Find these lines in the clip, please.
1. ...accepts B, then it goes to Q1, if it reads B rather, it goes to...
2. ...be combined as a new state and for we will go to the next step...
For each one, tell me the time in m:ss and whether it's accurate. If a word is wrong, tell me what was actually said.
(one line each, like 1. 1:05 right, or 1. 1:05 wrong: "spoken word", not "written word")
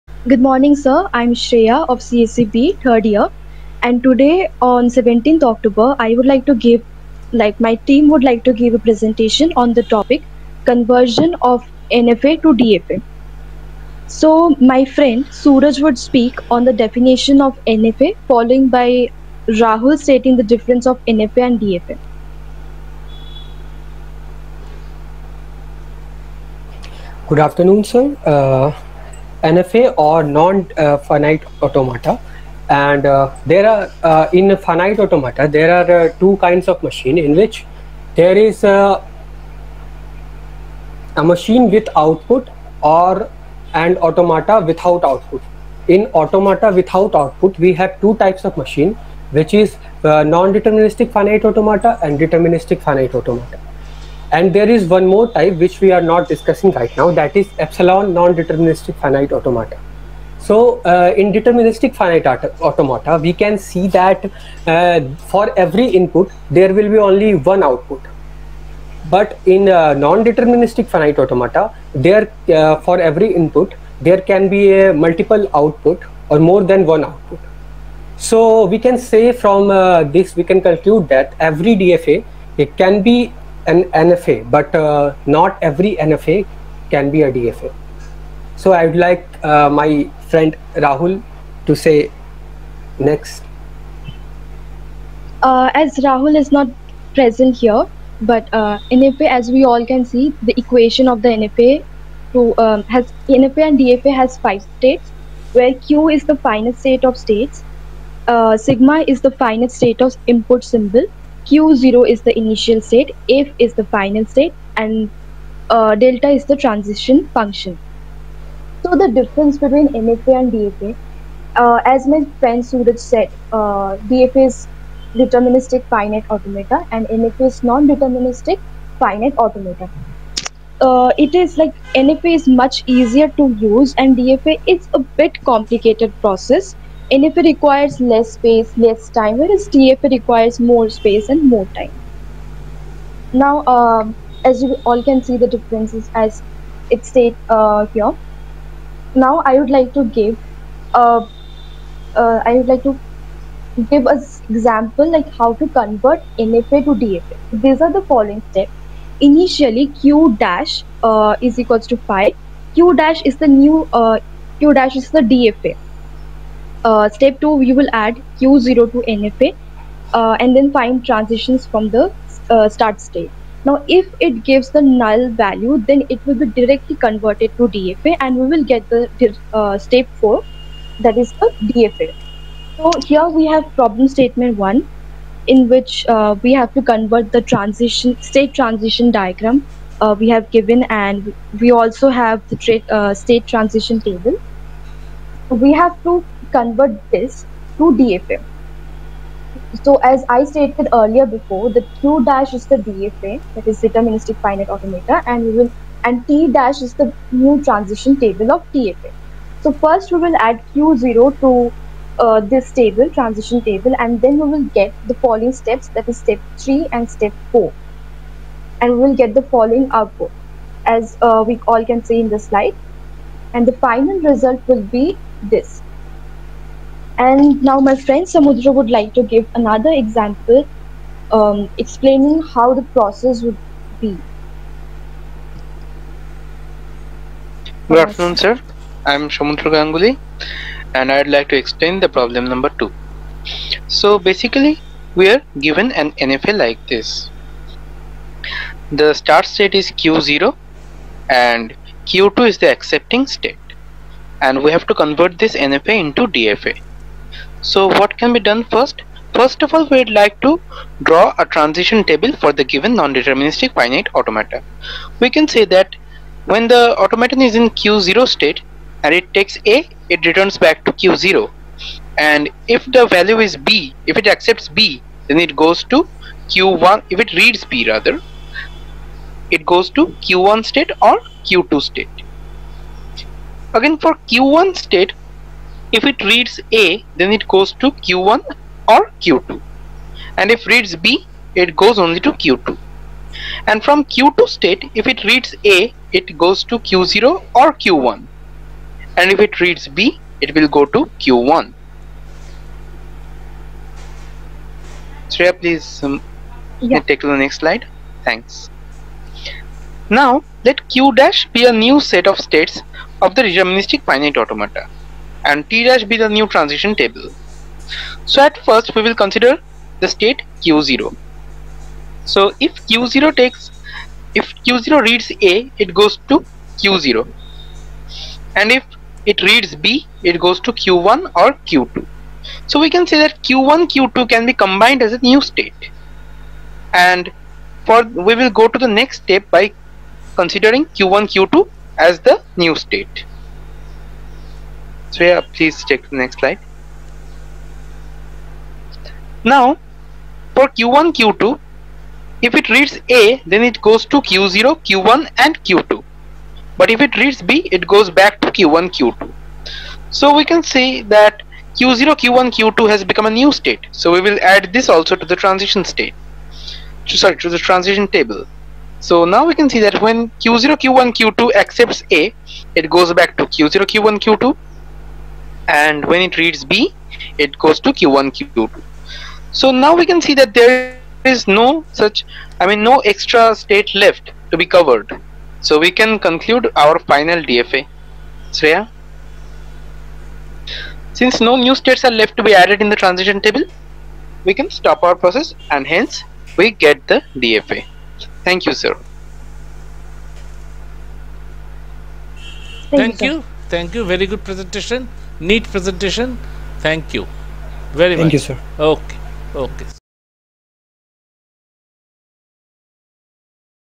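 1. 4:34 right
2. 5:34 right.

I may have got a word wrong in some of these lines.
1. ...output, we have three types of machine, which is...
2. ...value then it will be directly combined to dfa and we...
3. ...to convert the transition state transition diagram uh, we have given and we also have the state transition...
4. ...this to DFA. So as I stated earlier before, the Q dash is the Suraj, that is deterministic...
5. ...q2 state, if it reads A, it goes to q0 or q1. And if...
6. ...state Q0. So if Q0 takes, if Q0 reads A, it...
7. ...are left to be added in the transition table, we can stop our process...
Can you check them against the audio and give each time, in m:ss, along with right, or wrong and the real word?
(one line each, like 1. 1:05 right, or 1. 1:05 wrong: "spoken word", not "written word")
1. 0:47 wrong: "two", not "three"
2. 2:55 wrong: "converted", not "combined"
3. 3:06 right
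4. 3:17 wrong: "DFA", not "Suraj"
5. 4:54 right
6. 5:20 right
7. 6:32 right.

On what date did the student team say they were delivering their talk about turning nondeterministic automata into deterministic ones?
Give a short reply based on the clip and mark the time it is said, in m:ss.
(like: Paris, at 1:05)
17th October, at 0:04.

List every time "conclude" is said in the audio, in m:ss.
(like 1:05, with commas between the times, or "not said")
1:20, 6:26.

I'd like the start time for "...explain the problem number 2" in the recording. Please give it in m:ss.
4:01.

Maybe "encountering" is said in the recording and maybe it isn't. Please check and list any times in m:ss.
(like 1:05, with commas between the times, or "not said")
not said.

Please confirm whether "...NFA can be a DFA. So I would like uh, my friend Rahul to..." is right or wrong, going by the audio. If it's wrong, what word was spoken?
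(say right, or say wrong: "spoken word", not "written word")
right.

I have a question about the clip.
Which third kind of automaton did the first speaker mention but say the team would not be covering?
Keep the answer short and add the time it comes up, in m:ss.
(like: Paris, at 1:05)
epsilon non-deterministic finite automata, at 0:57.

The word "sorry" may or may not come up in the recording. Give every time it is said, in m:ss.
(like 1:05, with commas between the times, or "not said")
6:07.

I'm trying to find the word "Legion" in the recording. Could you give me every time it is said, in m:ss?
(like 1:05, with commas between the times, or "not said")
not said.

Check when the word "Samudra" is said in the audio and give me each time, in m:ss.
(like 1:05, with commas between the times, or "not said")
3:48, 3:59.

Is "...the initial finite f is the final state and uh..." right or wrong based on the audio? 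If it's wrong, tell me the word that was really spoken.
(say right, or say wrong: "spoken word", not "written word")
wrong: "state", not "finite".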